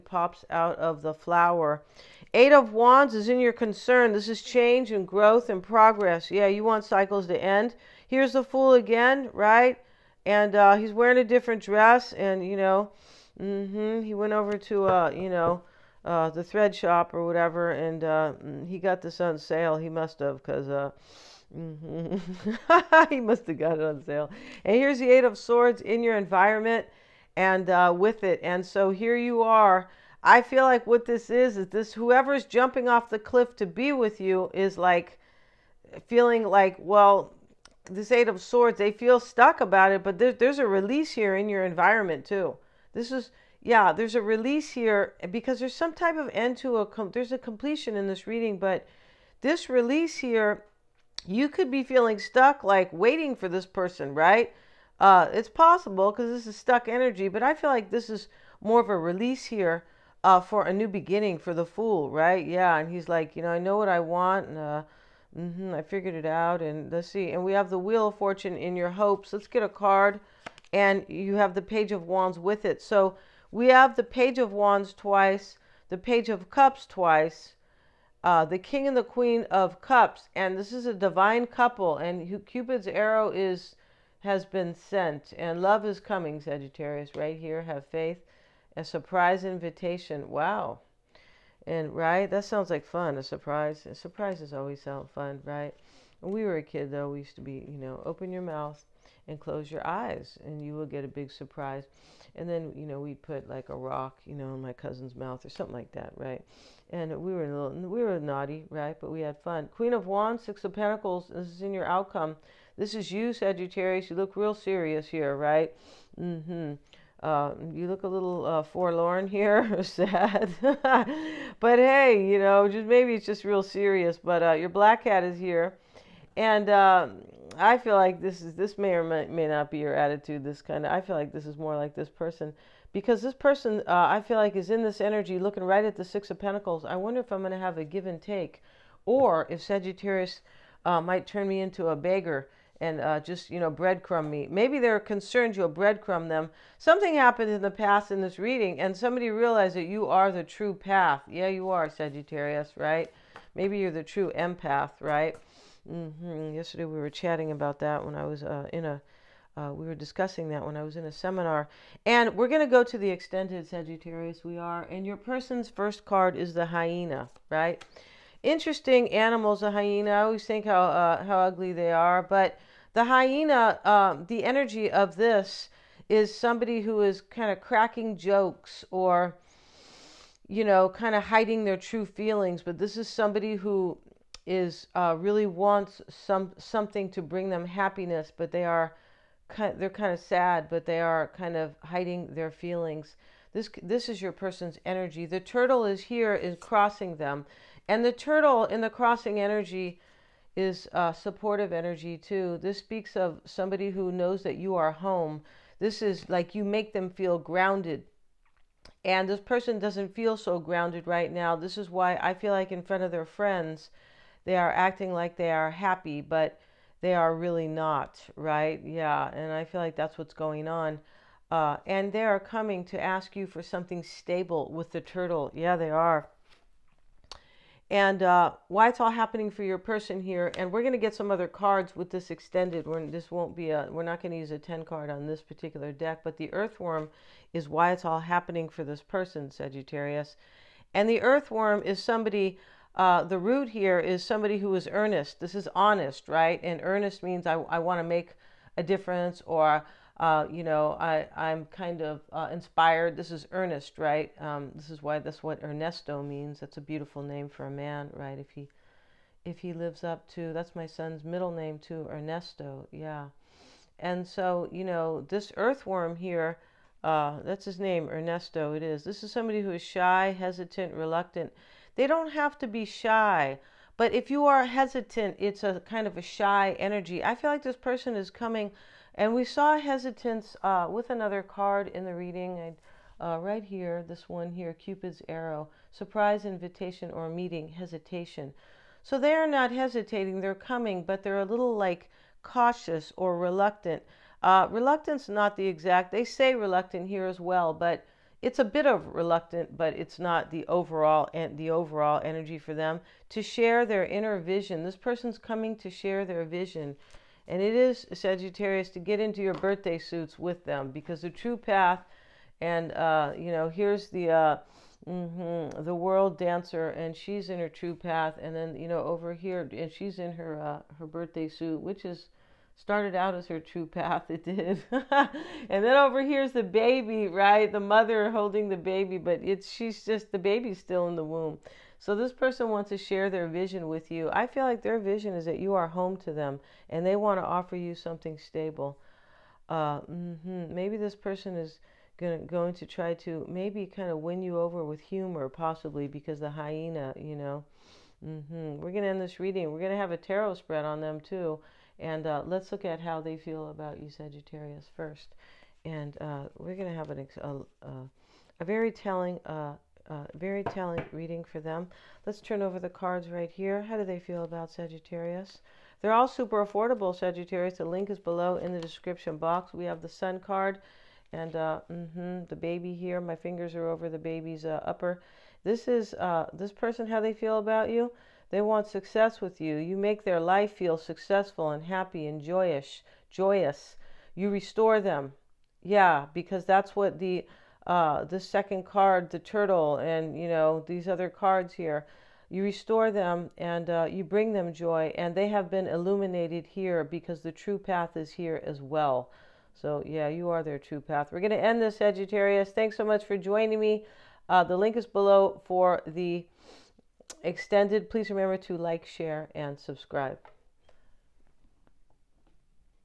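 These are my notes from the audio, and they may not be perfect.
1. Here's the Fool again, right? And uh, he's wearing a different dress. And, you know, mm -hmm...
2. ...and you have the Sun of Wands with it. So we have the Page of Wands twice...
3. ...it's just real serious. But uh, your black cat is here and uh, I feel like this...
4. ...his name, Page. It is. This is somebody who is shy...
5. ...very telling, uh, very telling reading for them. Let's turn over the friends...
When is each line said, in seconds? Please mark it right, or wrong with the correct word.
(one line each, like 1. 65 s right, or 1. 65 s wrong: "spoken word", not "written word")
1. 8 s right
2. 70 s wrong: "Page", not "Sun"
3. 123 s right
4. 267 s wrong: "Ernesto", not "Page"
5. 358 s wrong: "cards", not "friends".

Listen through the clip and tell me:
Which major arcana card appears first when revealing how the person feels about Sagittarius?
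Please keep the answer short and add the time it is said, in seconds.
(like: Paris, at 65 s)
the Sun, at 370 s.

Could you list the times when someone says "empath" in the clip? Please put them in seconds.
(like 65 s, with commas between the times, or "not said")
154 s.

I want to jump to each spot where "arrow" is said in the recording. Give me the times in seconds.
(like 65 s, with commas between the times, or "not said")
82 s, 285 s.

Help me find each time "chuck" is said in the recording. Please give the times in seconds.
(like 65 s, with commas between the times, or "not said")
not said.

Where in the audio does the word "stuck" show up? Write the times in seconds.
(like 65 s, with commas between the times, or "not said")
39 s, 52 s, 56 s.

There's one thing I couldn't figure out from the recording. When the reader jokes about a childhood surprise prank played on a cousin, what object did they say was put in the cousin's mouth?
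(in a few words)
a rock.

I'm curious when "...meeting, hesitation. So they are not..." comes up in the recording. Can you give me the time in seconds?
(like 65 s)
287 s.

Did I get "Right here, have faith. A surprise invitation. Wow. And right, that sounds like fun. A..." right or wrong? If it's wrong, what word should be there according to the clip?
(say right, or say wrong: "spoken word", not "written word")
right.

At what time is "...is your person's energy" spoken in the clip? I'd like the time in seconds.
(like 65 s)
194 s.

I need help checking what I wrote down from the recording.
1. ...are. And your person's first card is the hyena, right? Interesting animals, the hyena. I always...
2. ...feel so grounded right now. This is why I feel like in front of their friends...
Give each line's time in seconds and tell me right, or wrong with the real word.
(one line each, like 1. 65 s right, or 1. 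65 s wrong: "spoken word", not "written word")
1. 164 s right
2. 210 s right.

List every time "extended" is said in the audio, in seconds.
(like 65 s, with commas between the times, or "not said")
163 s, 232 s, 407 s.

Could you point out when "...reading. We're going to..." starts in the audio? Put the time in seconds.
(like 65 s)
349 s.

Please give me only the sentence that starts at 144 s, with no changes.
Maybe they're concerned you'll breadcrumb them.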